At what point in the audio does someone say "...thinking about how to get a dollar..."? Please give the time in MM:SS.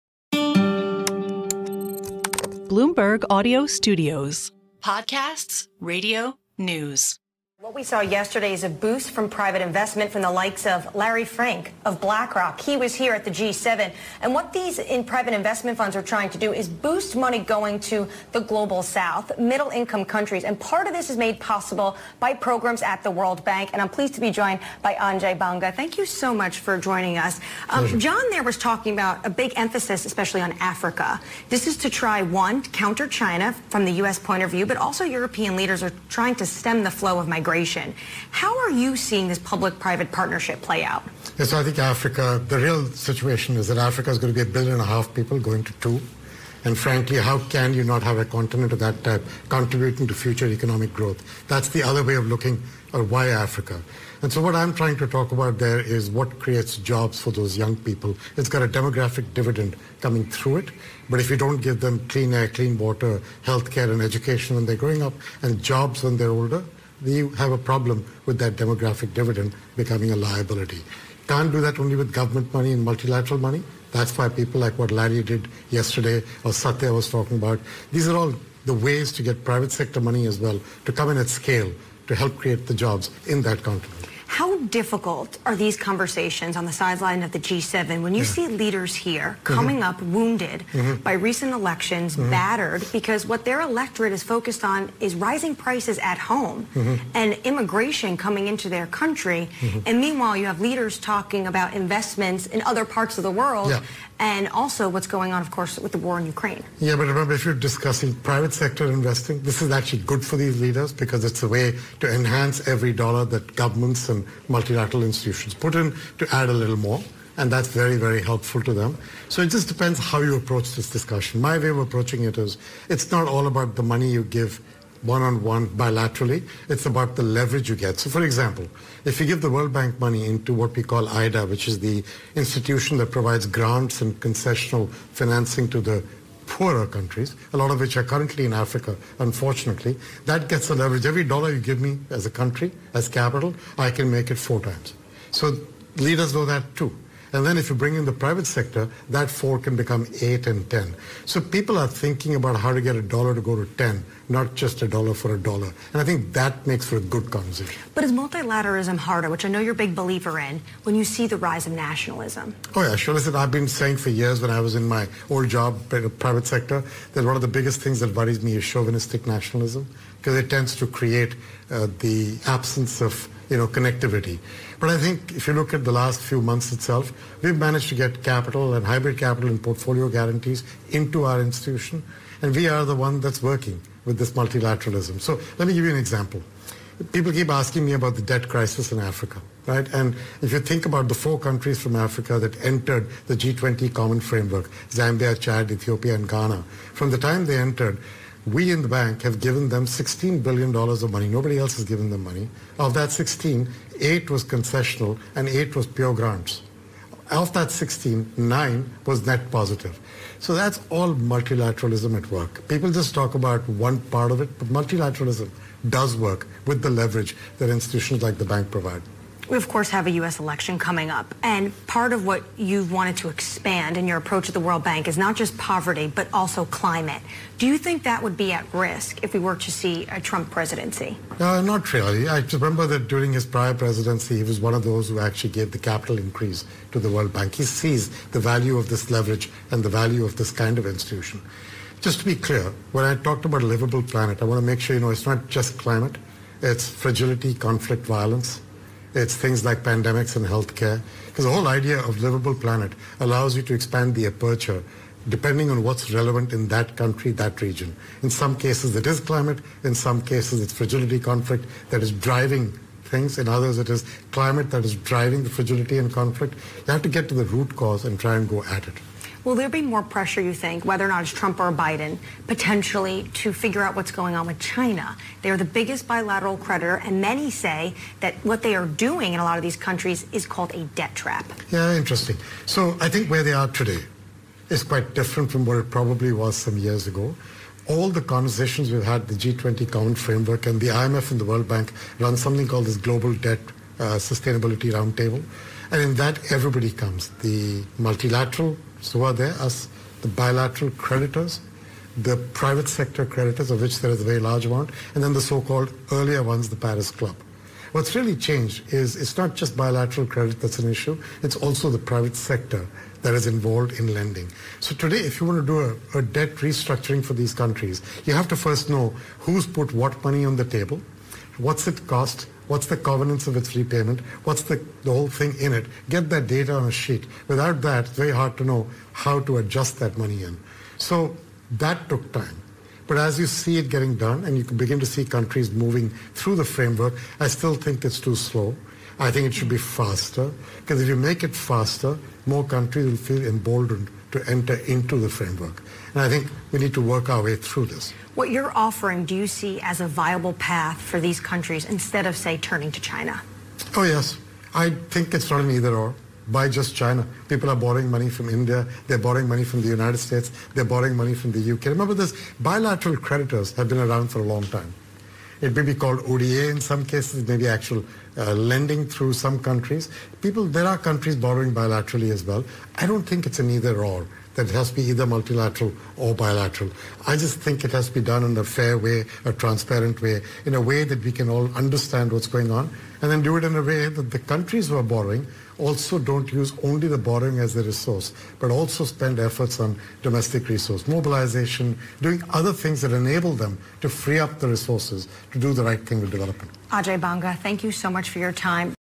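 02:31.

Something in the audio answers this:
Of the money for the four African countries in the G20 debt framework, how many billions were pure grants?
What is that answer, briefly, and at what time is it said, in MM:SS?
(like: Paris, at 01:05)
8, at 03:25.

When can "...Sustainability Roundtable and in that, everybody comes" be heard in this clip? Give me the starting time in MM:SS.
04:54.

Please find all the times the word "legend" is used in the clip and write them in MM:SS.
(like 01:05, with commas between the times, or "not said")
not said.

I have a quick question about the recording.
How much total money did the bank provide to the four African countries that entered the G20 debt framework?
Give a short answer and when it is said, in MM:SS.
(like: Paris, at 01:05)
$16 billion, at 03:19.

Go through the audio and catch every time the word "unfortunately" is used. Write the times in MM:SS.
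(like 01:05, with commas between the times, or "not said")
02:19.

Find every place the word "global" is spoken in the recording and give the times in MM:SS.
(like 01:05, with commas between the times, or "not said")
00:18, 04:52.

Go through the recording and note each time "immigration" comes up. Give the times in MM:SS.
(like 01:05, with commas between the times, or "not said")
01:37.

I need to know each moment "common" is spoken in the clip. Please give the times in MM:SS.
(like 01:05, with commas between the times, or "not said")
03:13, 04:49.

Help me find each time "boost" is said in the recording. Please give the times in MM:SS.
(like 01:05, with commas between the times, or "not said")
00:08, 00:16.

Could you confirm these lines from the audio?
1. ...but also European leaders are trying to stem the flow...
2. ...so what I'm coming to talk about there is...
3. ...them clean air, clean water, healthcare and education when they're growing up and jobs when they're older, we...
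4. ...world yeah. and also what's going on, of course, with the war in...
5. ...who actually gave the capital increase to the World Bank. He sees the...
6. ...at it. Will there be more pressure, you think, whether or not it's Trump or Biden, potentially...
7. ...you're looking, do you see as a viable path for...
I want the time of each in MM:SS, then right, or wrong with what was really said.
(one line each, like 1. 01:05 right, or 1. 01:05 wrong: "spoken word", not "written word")
1. 00:34 right
2. 00:54 wrong: "trying", not "coming"
3. 01:01 right
4. 01:43 right
5. 03:55 right
6. 04:28 right
7. 05:48 wrong: "offering", not "looking".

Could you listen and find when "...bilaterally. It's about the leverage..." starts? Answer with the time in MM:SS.
02:05.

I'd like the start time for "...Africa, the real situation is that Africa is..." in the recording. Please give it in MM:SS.
00:41.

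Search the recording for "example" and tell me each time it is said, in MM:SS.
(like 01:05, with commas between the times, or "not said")
02:08, 03:05.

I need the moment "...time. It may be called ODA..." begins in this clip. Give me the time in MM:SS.
06:04.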